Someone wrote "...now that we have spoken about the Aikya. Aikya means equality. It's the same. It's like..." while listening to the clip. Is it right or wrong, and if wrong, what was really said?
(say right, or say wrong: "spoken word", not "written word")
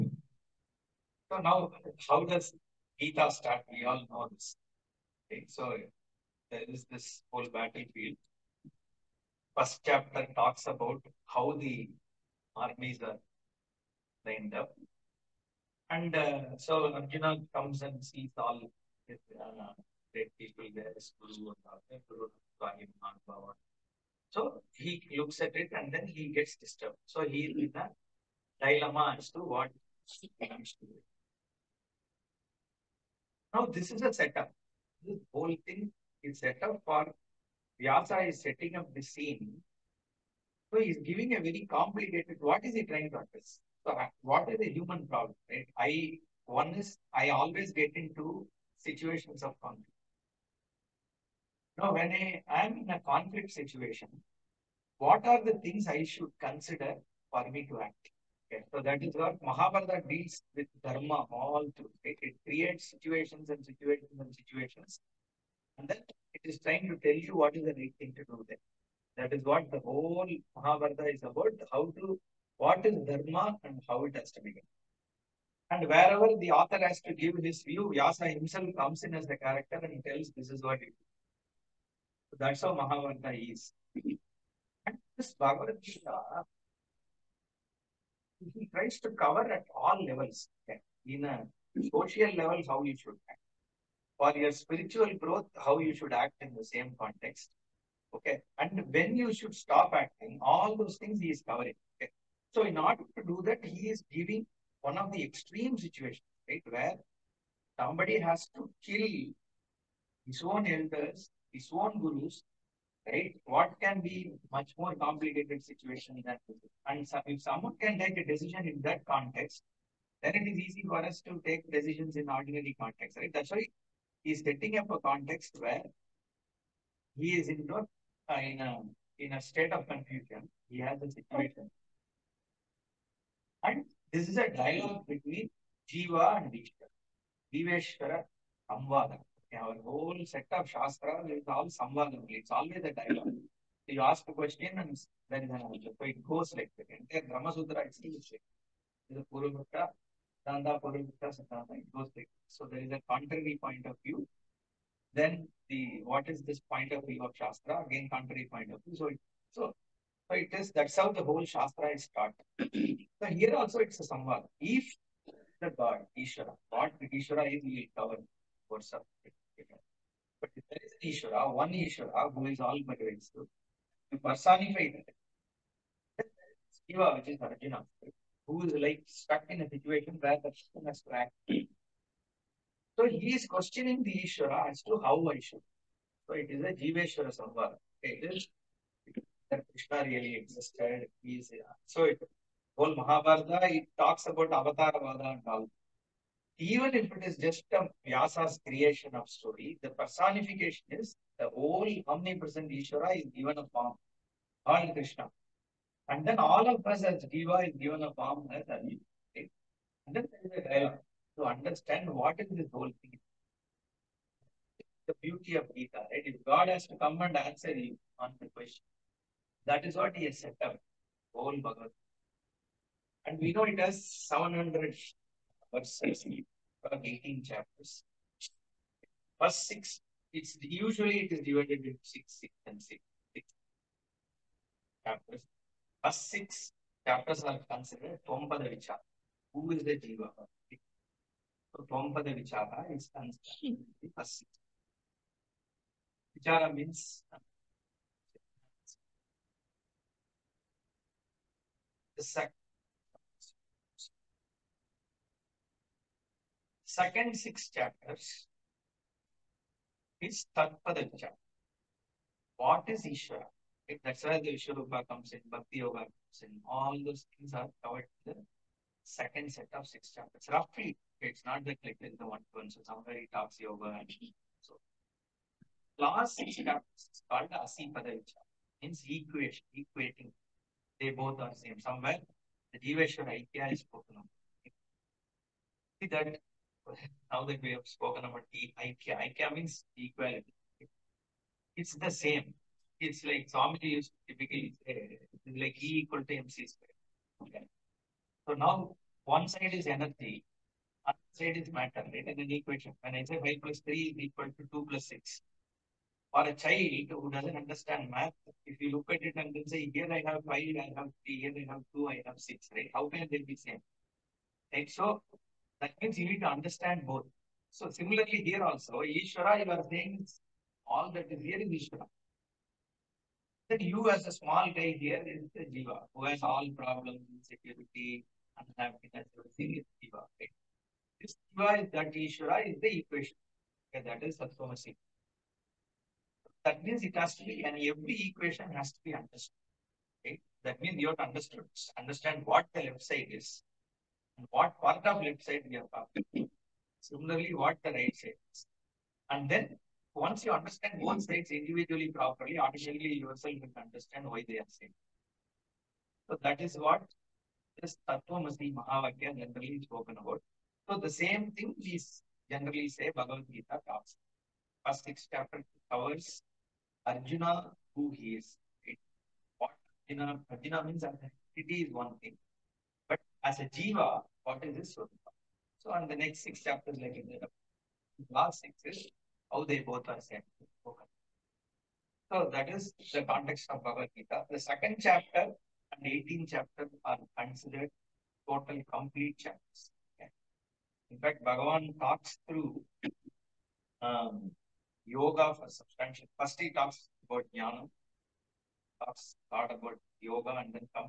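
right.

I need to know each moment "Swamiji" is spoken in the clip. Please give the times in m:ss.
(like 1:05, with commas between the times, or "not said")
4:53.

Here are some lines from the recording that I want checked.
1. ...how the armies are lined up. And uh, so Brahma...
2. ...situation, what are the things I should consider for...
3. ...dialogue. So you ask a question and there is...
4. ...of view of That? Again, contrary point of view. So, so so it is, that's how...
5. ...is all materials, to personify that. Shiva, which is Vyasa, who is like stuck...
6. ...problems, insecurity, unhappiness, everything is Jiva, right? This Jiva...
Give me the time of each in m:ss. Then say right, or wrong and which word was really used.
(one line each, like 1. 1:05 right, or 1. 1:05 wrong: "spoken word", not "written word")
1. 0:11 wrong: "Arjuna", not "Brahma"
2. 0:53 right
3. 2:22 right
4. 2:36 wrong: "Shastra", not "That"
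5. 2:52 wrong: "Arjuna", not "Vyasa"
6. 5:26 right.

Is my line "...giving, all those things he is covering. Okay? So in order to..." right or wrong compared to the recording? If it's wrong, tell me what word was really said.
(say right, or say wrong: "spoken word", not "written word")
wrong: "acting", not "giving".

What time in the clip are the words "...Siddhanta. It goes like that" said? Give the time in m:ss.
2:31.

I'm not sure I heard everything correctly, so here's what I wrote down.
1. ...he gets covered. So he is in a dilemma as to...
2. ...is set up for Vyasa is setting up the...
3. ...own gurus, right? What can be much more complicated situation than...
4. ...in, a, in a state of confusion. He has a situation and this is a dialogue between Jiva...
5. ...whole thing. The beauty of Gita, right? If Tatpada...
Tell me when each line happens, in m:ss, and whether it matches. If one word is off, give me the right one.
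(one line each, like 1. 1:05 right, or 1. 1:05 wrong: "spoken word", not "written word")
1. 0:26 wrong: "disturbed", not "covered"
2. 0:36 right
3. 1:51 right
4. 2:08 right
5. 3:32 wrong: "God", not "Tatpada".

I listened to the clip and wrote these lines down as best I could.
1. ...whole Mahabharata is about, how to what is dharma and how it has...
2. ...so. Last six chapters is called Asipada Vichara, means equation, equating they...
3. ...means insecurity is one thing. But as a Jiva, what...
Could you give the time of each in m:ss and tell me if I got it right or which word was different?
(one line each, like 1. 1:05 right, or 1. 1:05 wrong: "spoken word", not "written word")
1. 1:09 right
2. 4:34 right
3. 6:10 wrong: "identity", not "insecurity".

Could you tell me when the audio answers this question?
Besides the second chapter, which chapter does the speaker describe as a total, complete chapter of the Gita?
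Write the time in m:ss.
6:26.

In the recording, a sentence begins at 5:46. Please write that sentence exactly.
Similarly, what the right side is.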